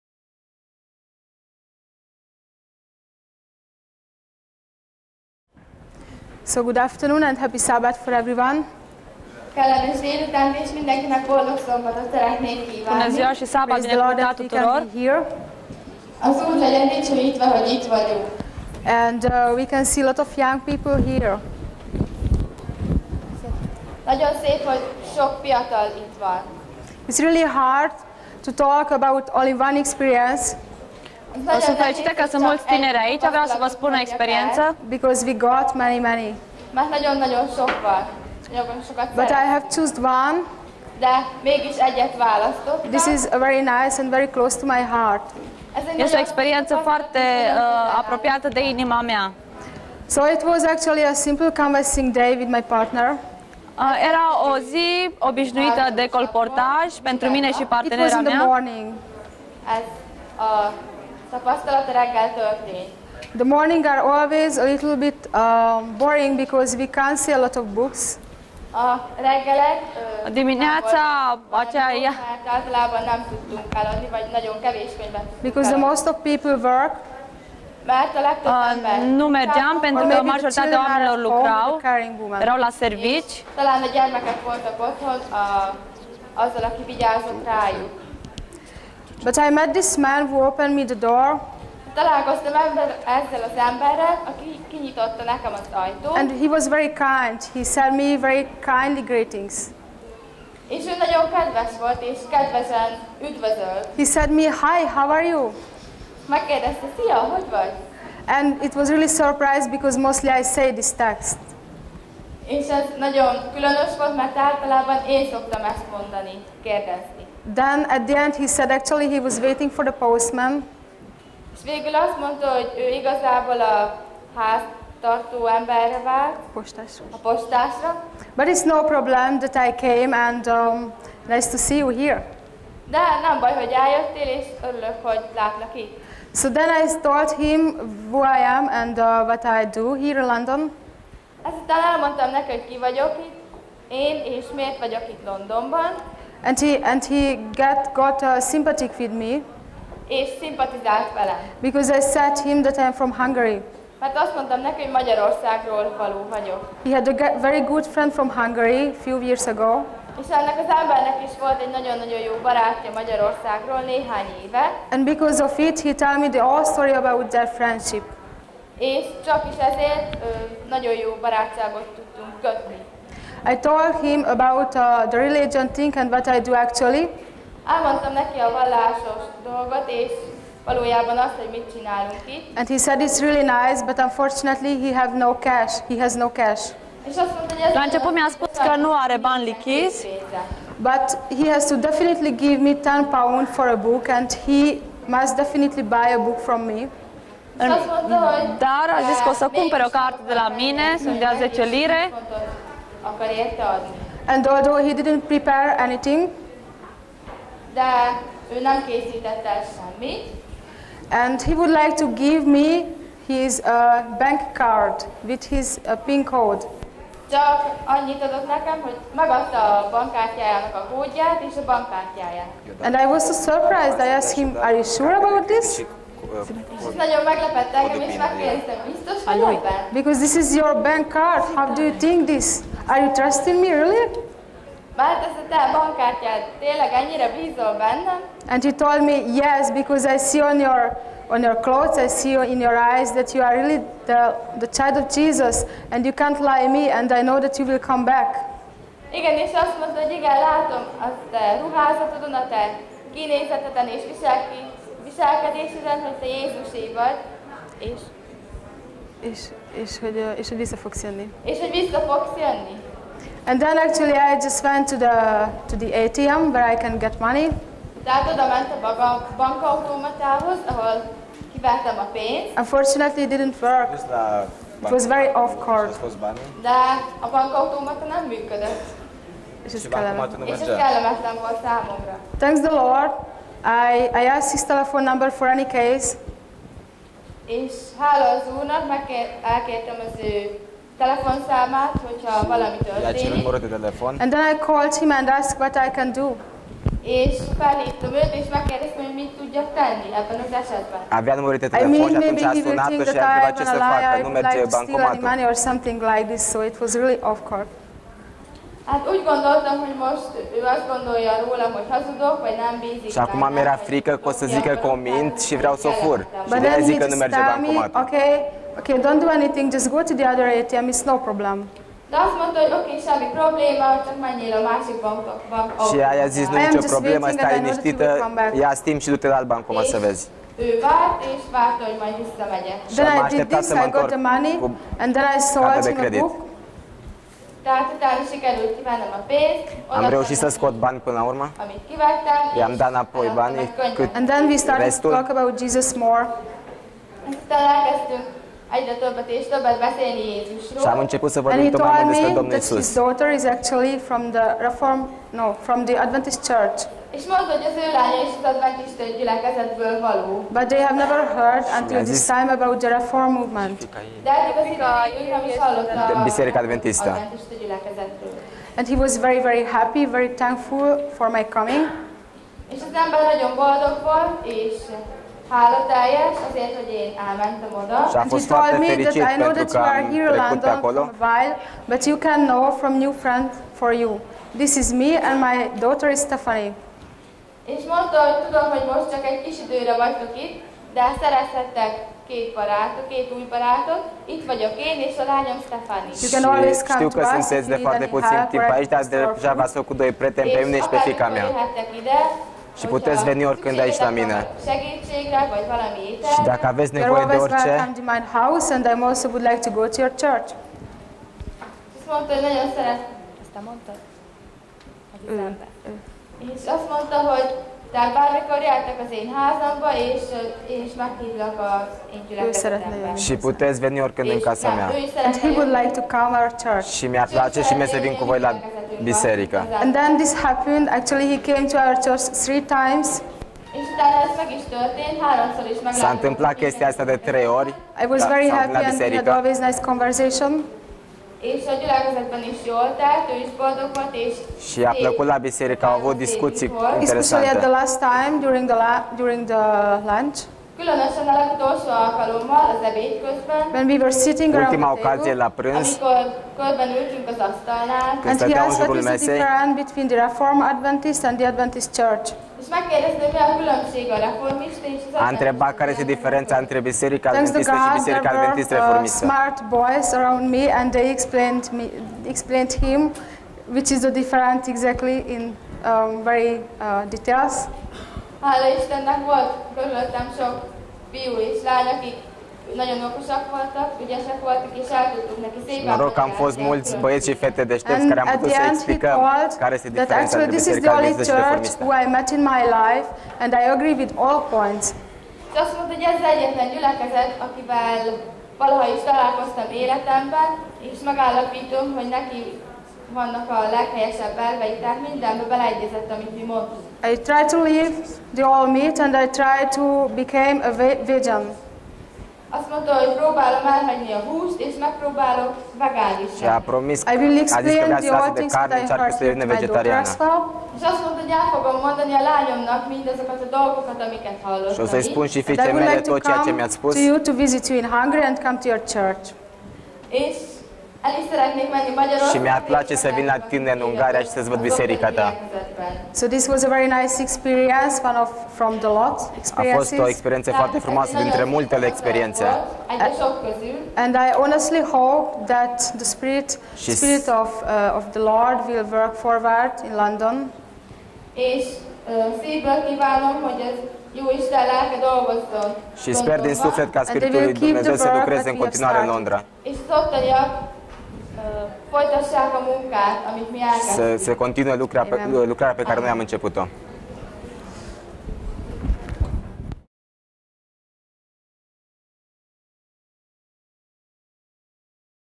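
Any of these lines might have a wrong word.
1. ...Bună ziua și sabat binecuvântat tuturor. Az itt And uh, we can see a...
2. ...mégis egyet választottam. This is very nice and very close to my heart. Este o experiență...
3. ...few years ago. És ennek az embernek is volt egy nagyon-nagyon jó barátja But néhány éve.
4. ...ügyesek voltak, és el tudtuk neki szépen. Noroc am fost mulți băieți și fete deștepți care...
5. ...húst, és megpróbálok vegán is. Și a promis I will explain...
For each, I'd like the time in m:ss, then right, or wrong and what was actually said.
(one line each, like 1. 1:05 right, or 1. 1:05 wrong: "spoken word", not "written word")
1. 0:12 right
2. 0:41 right
3. 2:39 wrong: "Magyarországról", not "But"
4. 8:04 right
5. 8:34 right.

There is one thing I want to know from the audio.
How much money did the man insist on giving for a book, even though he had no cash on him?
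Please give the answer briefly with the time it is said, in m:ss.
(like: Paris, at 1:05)
10 pounds, at 3:12.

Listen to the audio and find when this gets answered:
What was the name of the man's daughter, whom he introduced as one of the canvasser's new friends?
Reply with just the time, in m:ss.
6:26.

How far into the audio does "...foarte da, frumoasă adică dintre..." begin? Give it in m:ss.
9:00.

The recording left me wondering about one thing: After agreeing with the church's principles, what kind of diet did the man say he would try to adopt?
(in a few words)
Vegan.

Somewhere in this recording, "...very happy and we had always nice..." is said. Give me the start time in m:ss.
7:18.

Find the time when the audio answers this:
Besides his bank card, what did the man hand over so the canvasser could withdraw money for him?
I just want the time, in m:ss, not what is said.
3:36.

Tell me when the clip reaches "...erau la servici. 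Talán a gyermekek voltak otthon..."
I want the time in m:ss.
1:22.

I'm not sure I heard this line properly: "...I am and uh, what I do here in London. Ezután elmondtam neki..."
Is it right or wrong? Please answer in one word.
right.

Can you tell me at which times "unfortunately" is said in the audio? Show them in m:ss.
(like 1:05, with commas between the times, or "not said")
3:03, 4:32.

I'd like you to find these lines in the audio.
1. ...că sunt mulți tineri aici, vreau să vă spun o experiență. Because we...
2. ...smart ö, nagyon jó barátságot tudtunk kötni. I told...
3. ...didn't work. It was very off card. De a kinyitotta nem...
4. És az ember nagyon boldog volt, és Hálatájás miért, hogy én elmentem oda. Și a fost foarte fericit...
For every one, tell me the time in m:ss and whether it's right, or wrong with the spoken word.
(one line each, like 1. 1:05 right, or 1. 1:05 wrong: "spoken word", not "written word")
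1. 0:32 right
2. 2:49 wrong: "ezért", not "smart"
3. 4:33 wrong: "bankautomata", not "kinyitotta"
4. 6:12 wrong: "azért", not "miért".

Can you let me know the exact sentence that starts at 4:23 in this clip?
And then actually I just went to the, to the ATM where I can get money.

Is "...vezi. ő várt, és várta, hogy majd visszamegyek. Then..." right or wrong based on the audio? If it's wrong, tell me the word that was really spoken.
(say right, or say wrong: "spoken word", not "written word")
right.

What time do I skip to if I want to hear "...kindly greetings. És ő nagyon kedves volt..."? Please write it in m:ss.
1:38.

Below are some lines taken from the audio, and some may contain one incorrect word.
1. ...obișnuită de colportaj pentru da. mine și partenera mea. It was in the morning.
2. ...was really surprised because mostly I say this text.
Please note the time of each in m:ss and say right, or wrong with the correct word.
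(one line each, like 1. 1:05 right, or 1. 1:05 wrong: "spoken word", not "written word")
1. 0:55 right
2. 1:48 right.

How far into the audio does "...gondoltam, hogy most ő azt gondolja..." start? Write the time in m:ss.
5:09.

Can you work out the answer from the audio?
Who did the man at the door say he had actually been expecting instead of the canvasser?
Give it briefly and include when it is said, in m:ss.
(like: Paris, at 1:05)
The postman, at 1:59.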